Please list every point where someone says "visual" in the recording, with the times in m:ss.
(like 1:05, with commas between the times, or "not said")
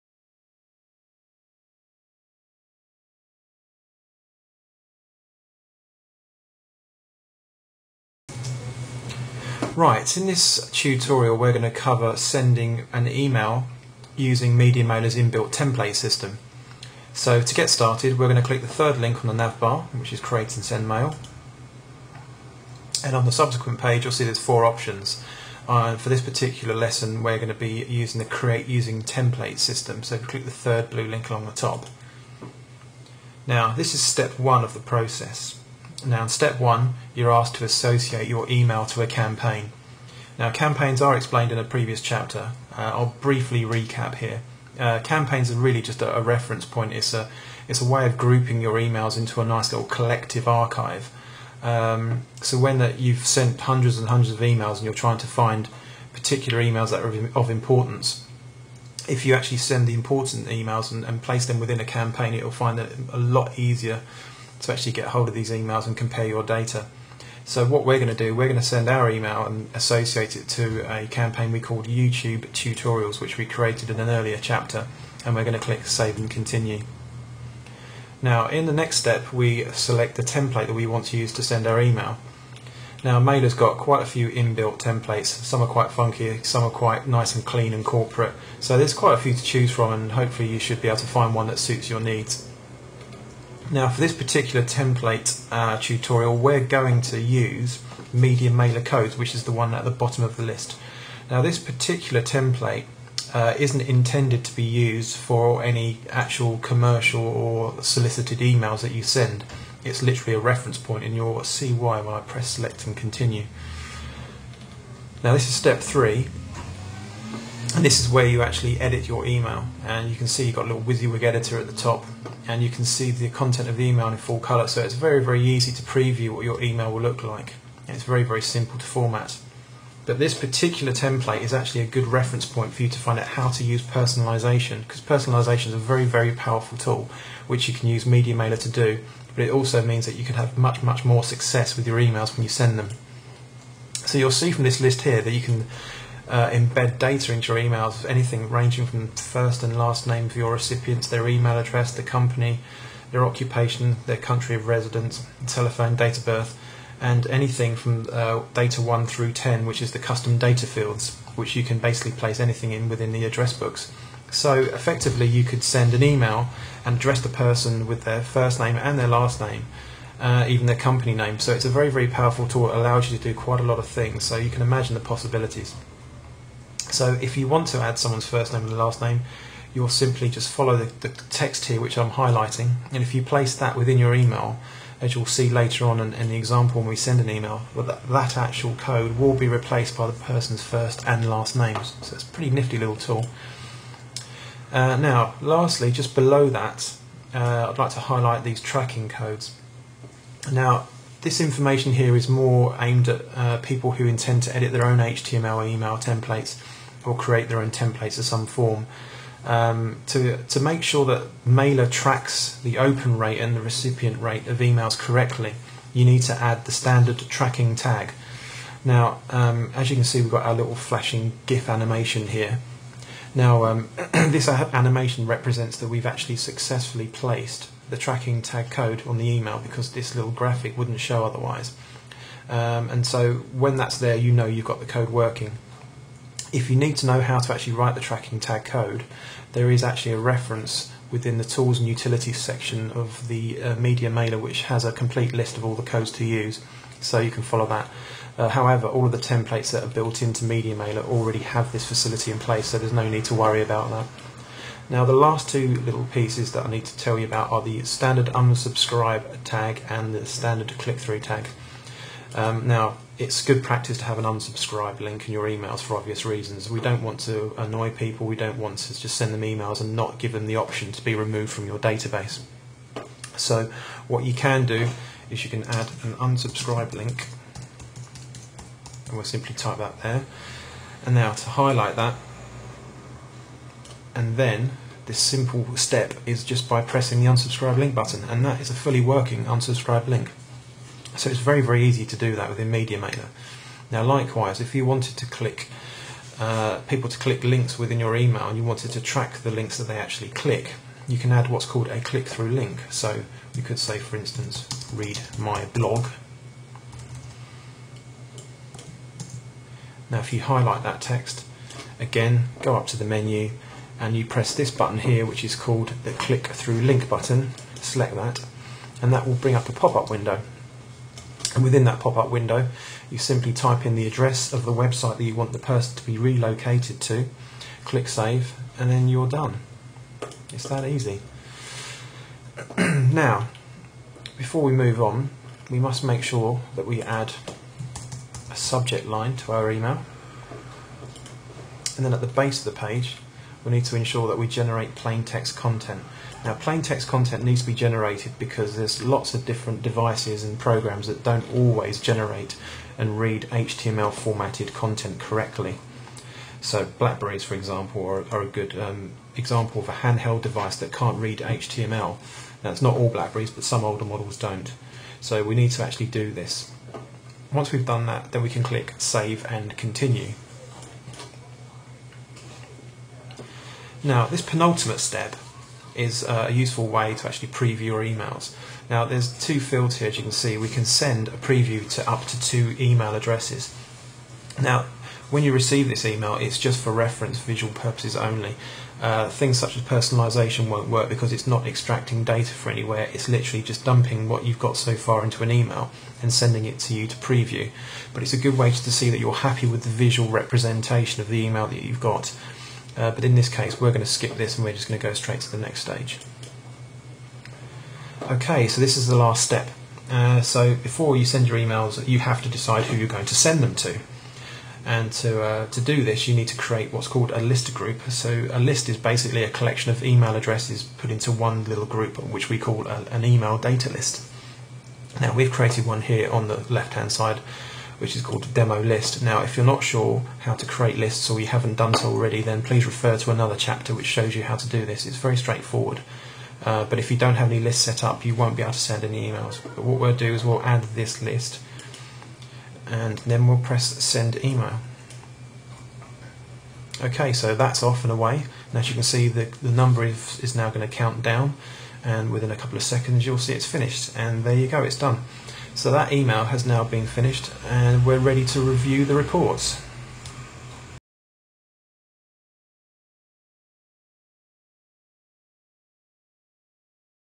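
6:27, 6:39.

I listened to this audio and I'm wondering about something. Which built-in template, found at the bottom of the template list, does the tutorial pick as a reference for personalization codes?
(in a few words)
Media Mailer Codes.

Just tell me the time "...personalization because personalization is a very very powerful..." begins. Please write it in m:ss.
2:13.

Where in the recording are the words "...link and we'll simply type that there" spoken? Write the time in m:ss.
4:36.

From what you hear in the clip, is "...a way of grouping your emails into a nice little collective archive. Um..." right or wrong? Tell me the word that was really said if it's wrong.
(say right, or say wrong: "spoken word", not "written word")
right.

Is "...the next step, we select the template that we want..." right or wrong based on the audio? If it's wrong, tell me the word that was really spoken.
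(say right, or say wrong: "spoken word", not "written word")
right.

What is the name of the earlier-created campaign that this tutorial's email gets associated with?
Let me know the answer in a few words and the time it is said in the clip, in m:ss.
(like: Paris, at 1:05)
YouTube Tutorials, at 1:11.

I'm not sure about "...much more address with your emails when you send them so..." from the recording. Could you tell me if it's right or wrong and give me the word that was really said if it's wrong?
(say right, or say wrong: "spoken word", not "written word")
wrong: "success", not "address".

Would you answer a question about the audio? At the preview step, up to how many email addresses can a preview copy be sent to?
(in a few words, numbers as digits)
2.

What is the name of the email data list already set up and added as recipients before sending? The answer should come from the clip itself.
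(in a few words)
demo list.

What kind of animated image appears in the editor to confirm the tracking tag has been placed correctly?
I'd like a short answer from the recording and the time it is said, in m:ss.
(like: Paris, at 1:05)
flashing GIF, at 3:40.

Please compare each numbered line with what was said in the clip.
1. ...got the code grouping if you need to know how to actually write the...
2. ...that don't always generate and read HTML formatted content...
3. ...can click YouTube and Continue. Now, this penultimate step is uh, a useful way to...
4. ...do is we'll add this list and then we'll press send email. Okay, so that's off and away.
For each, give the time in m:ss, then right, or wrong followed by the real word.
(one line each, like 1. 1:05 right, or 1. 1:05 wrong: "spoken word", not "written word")
1. 3:54 wrong: "working", not "grouping"
2. 5:51 right
3. 6:08 wrong: "Save", not "YouTube"
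4. 7:20 right.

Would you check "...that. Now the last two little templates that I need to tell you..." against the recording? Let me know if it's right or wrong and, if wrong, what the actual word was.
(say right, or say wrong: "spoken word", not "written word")
wrong: "pieces", not "templates".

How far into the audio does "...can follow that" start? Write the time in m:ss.
4:07.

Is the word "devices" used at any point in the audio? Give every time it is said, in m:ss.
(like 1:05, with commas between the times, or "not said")
5:49, 6:00.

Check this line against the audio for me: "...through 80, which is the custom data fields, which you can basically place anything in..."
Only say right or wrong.
wrong.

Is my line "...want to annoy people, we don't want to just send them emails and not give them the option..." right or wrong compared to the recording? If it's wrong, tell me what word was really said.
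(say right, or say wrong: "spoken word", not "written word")
right.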